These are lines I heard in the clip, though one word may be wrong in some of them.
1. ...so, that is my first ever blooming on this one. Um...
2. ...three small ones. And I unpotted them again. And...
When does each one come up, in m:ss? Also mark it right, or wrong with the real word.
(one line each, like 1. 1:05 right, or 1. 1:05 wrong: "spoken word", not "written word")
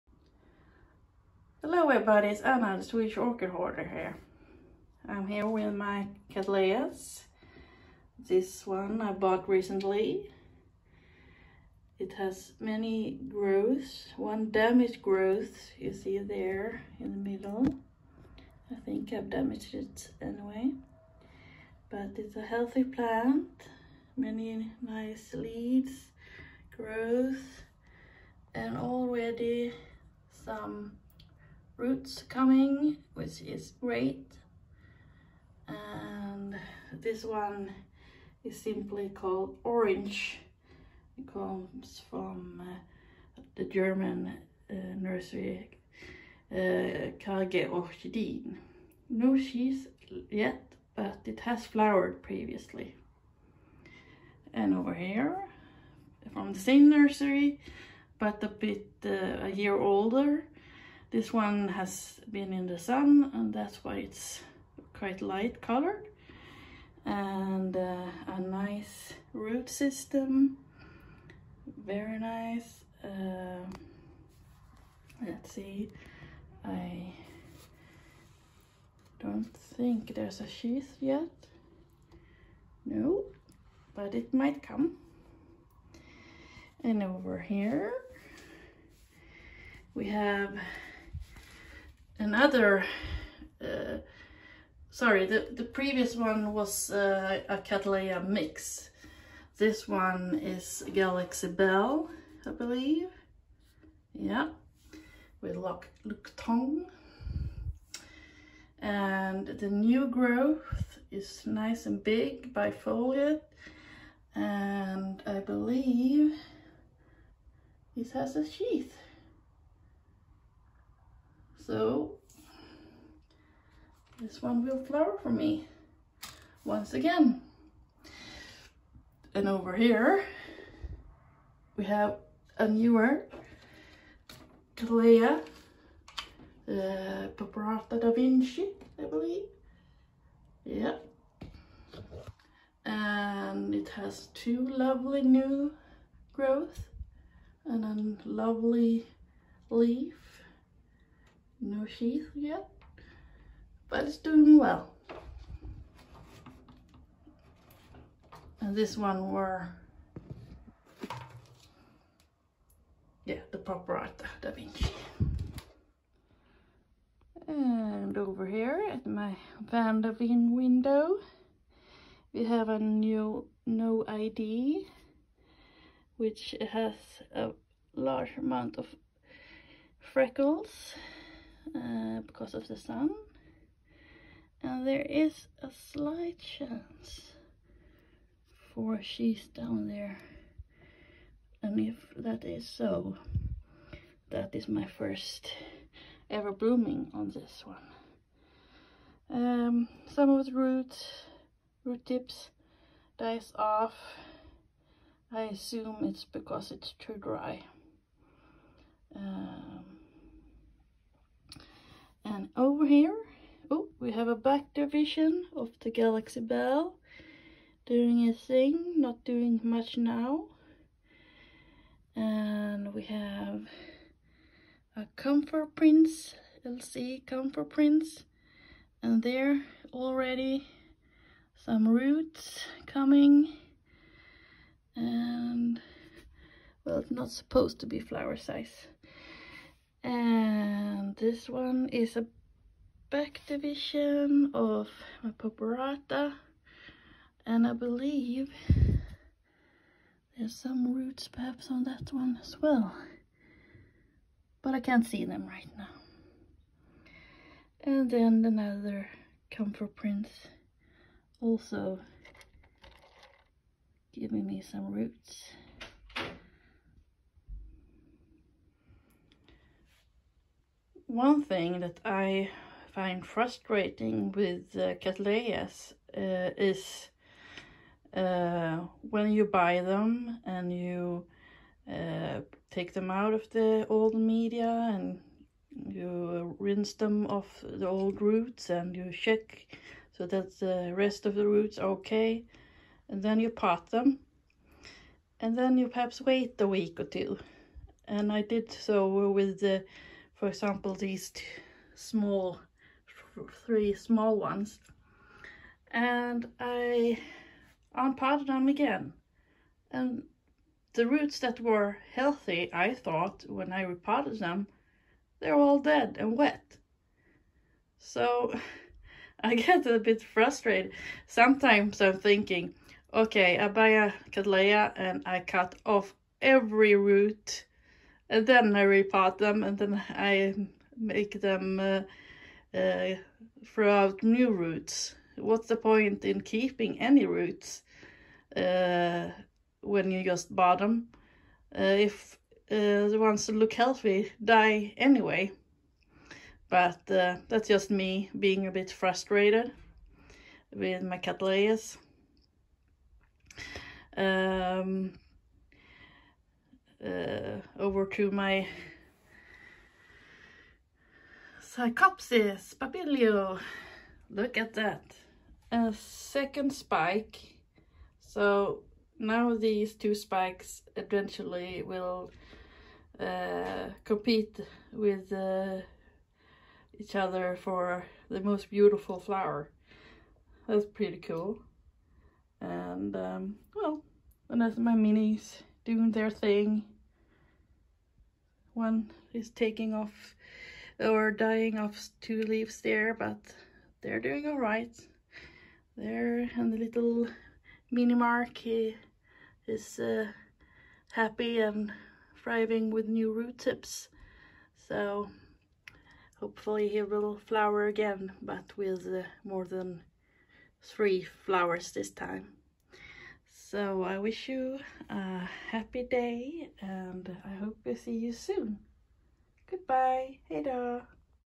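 1. 3:12 right
2. 5:03 right.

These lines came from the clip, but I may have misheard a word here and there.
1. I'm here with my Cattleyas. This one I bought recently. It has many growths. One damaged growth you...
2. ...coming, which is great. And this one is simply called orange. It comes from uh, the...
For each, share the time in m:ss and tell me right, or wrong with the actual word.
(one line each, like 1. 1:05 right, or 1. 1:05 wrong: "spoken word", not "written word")
1. 0:05 right
2. 0:32 right.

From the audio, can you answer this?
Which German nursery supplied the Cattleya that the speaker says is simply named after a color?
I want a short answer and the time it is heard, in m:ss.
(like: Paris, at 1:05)
Kage Orchidin, at 0:47.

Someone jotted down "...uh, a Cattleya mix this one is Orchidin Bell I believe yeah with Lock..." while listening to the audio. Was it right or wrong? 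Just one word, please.
wrong.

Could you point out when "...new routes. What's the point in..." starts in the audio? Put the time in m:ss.
5:34.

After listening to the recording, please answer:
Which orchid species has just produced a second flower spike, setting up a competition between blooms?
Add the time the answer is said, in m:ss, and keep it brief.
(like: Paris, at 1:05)
Psychopsis papilio, at 6:01.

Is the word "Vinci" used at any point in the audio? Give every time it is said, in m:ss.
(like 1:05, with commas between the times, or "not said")
2:18, 2:44.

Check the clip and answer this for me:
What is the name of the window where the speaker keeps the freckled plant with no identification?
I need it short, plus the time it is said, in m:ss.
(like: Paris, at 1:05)
Van der Veen, at 2:49.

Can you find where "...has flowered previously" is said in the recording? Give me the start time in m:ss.
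0:51.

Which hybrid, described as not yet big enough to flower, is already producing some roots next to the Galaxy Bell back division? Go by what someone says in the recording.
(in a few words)
LC Comfort Prince.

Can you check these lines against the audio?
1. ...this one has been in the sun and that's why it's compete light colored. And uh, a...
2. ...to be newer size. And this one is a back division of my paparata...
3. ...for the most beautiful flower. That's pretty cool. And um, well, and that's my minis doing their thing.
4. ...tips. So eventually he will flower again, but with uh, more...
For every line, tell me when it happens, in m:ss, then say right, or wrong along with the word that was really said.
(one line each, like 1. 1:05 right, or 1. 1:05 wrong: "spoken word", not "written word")
1. 1:01 wrong: "quite", not "compete"
2. 3:57 wrong: "flower", not "newer"
3. 6:17 right
4. 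6:43 wrong: "hopefully", not "eventually".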